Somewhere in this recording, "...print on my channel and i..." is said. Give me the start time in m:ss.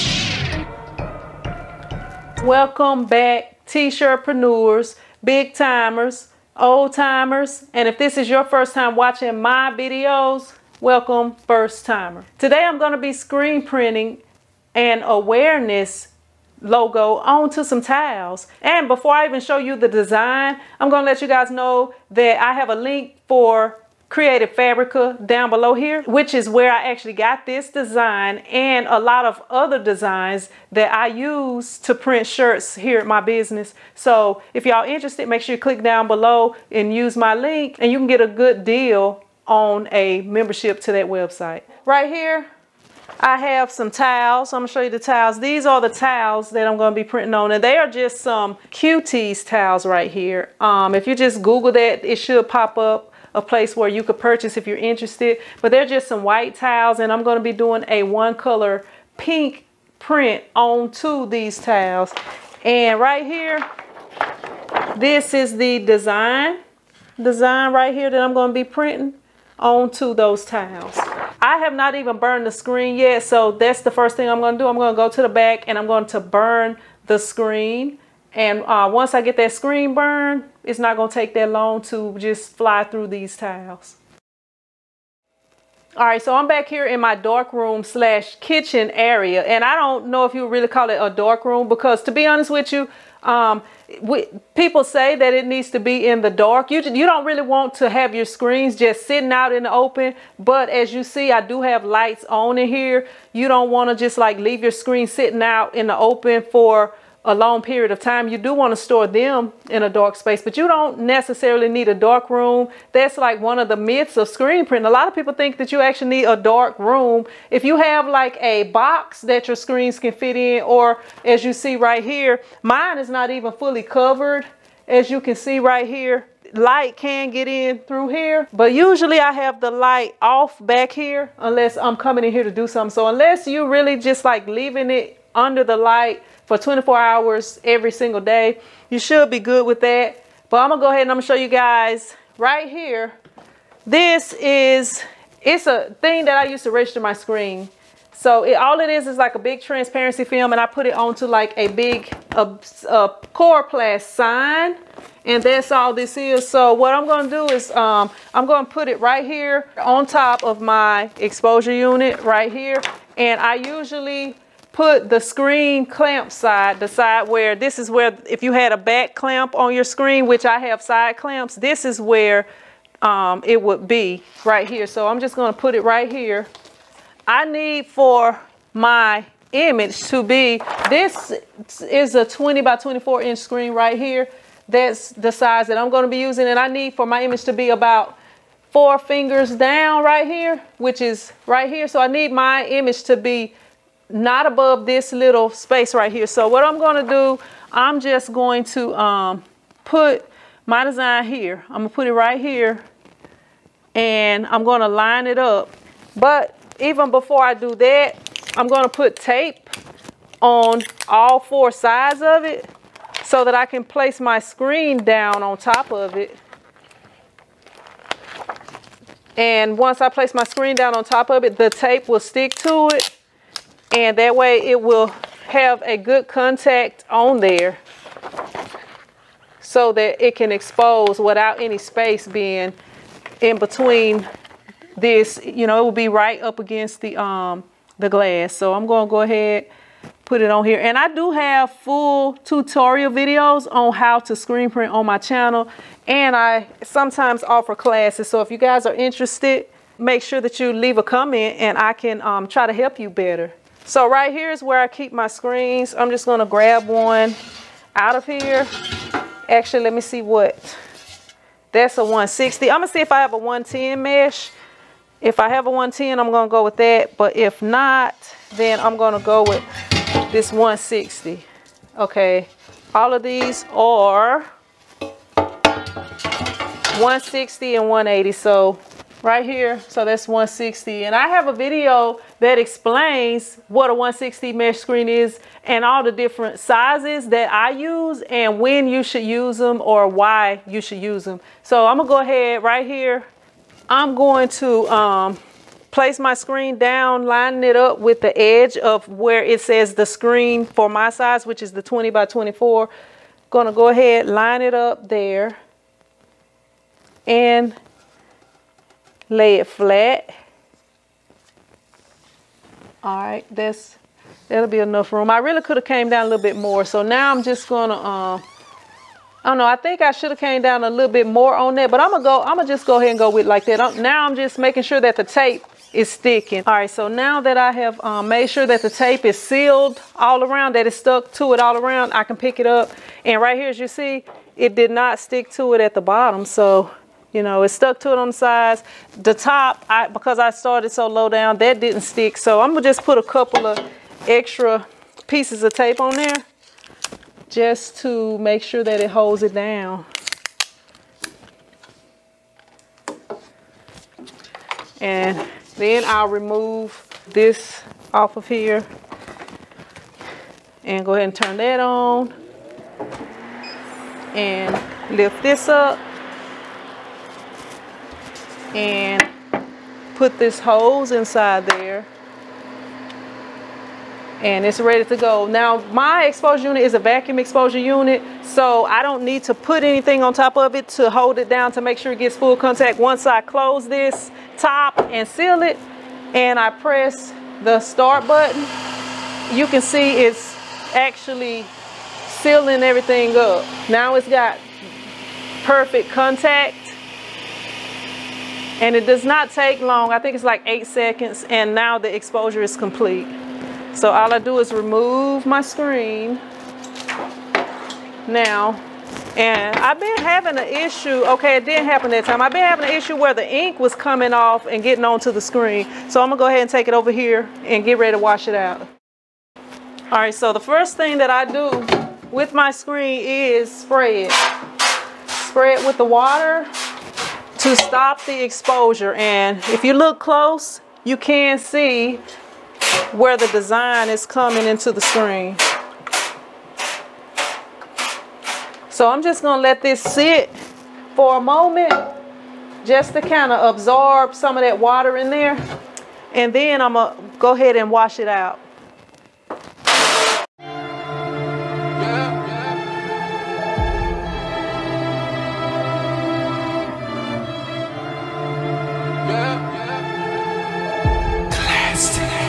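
4:04.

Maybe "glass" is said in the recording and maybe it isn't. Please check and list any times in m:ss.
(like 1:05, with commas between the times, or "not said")
3:58.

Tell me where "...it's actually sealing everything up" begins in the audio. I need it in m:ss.
6:30.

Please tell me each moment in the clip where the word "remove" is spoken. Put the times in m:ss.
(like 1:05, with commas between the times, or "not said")
5:56, 6:44.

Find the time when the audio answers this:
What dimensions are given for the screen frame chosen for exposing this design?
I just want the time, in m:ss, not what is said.
3:02.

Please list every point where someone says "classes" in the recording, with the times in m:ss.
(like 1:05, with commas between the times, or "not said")
4:07.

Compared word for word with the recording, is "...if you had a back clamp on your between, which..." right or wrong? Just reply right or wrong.
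wrong.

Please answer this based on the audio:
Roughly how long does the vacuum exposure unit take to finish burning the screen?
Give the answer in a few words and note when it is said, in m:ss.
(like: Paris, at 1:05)
8 seconds, at 6:40.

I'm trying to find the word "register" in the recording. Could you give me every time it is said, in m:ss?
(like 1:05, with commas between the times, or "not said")
2:26.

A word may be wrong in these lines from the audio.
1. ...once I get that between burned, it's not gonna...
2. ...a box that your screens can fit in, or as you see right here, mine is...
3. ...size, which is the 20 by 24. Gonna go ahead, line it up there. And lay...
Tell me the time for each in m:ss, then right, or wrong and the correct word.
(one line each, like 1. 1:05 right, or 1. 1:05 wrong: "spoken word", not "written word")
1. 1:18 wrong: "screen", not "between"
2. 1:58 right
3. 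5:01 right.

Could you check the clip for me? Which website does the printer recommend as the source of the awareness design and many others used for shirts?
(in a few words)
Creative Fabrica.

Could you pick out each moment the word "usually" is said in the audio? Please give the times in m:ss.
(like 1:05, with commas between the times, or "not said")
2:08, 2:43.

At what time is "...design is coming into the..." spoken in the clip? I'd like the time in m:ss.
7:13.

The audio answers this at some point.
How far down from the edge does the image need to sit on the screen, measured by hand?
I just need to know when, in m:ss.
3:08.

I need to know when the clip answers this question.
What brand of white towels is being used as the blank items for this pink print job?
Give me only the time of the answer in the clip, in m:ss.
0:48.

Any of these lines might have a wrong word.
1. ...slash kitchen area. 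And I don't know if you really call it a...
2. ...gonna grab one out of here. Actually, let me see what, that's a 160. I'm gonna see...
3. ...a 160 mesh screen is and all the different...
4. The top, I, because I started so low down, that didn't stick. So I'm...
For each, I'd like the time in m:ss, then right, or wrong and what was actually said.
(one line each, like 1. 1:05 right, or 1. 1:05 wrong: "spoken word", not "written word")
1. 1:27 right
2. 4:16 right
3. 4:43 right
4. 5:39 right.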